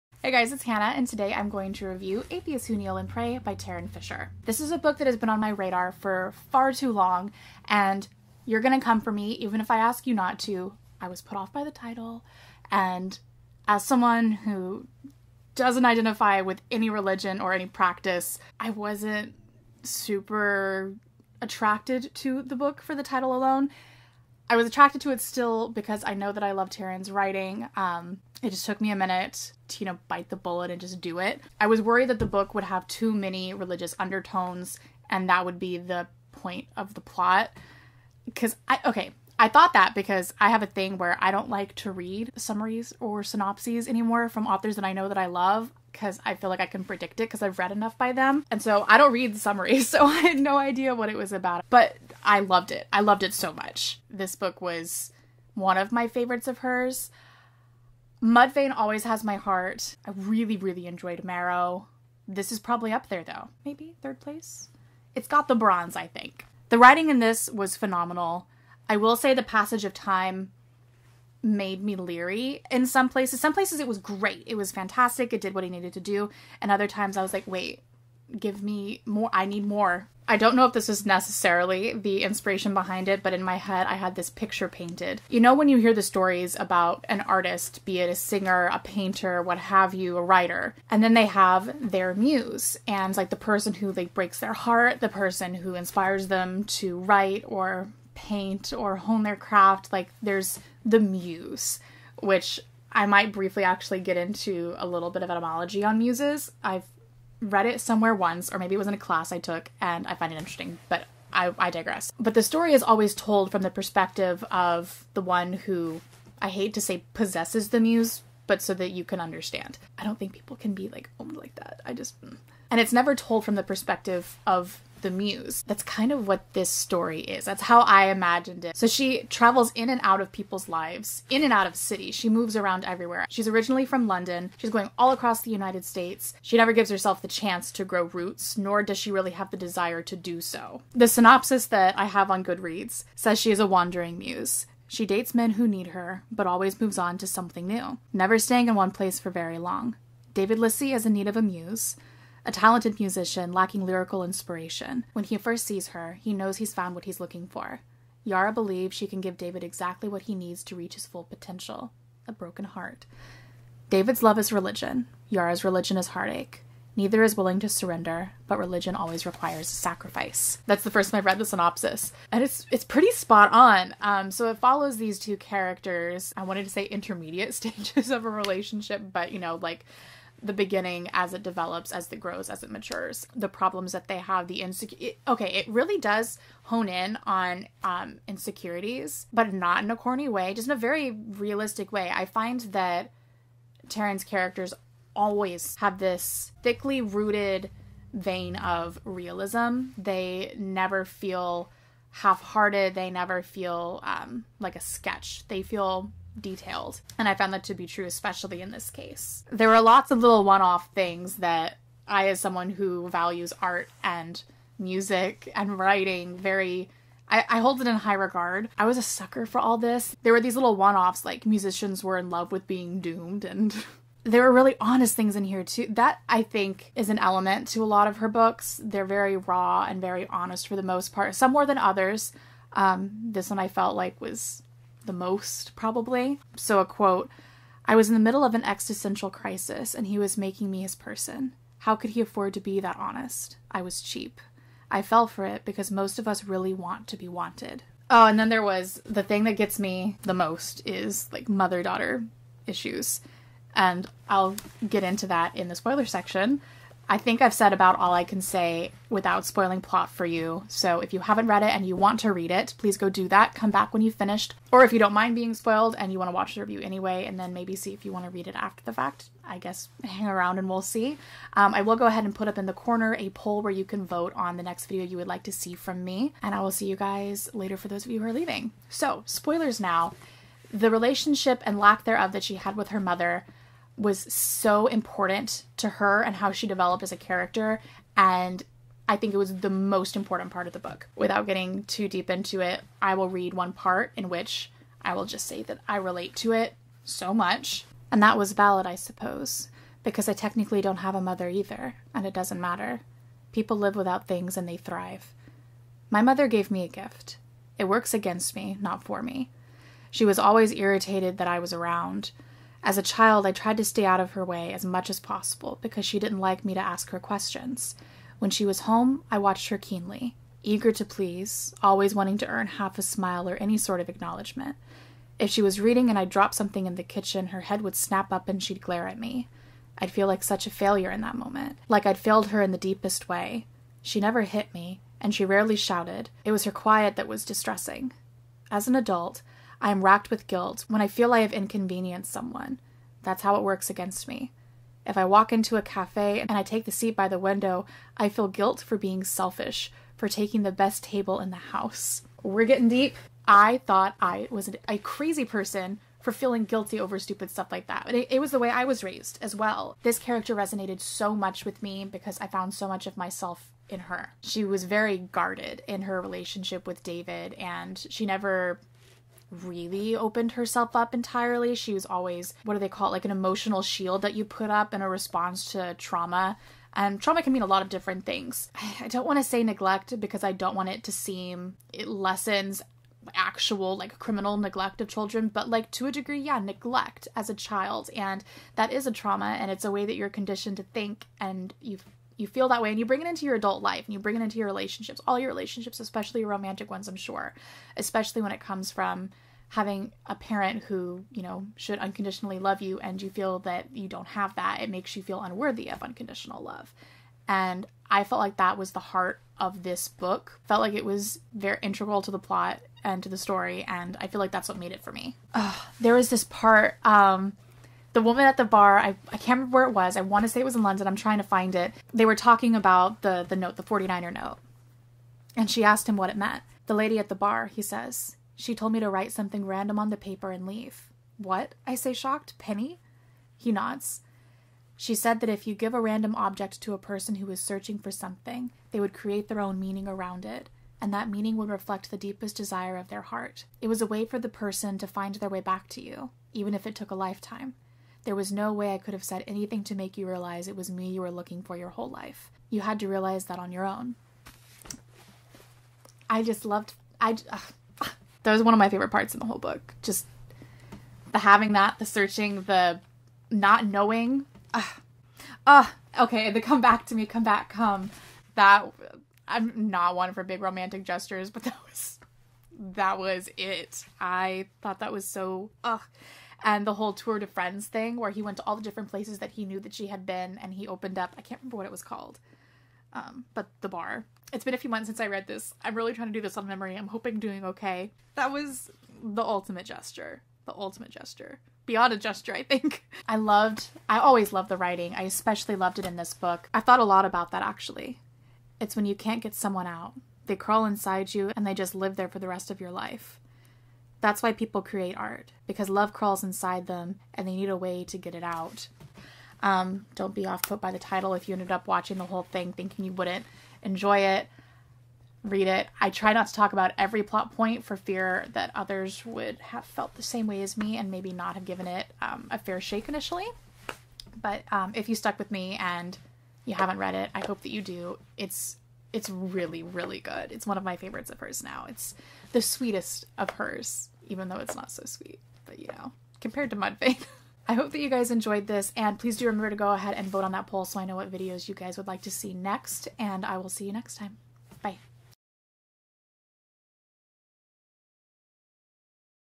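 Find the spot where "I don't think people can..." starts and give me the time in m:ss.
1:59.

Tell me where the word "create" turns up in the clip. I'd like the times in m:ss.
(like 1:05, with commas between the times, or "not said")
7:19, 8:24.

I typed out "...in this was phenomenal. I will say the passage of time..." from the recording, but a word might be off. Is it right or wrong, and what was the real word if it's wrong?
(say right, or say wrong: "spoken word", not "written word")
right.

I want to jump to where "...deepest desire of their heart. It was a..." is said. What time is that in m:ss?
7:22.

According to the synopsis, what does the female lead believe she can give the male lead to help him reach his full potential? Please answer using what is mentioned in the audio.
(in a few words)
a broken heart.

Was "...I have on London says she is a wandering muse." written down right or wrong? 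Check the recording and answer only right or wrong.
wrong.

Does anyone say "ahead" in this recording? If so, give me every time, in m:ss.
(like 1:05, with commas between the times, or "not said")
4:32, 8:59.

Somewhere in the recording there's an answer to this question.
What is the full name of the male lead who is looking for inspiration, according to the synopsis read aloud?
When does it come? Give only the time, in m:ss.
2:30.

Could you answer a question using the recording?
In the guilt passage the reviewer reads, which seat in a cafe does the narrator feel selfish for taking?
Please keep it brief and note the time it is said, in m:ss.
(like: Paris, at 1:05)
the seat by the window, at 5:46.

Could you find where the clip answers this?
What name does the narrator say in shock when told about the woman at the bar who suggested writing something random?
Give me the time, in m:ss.
7:12.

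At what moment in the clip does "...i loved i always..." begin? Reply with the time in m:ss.
8:13.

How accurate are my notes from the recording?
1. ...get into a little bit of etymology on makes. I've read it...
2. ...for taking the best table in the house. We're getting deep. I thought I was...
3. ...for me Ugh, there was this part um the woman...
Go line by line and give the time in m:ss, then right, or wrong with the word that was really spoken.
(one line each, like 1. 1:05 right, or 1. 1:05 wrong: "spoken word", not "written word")
1. 1:44 wrong: "muses", not "makes"
2. 5:50 right
3. 6:55 right.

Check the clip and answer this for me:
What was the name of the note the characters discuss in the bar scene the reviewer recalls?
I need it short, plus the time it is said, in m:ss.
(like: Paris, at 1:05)
the 49er note, at 7:03.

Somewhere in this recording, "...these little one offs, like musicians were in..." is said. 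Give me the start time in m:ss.
3:40.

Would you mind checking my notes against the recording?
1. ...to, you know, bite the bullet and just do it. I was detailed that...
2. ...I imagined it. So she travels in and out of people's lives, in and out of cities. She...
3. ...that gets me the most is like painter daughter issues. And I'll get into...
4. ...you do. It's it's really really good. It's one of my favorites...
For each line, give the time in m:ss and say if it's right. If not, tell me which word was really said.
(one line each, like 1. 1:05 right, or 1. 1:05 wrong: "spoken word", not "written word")
1. 0:29 wrong: "worried", not "detailed"
2. 2:07 right
3. 4:09 wrong: "mother", not "painter"
4. 8:47 right.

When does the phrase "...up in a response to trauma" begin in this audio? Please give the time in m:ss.
6:14.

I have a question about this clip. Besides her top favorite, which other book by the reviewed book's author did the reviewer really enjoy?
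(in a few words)
Marrow.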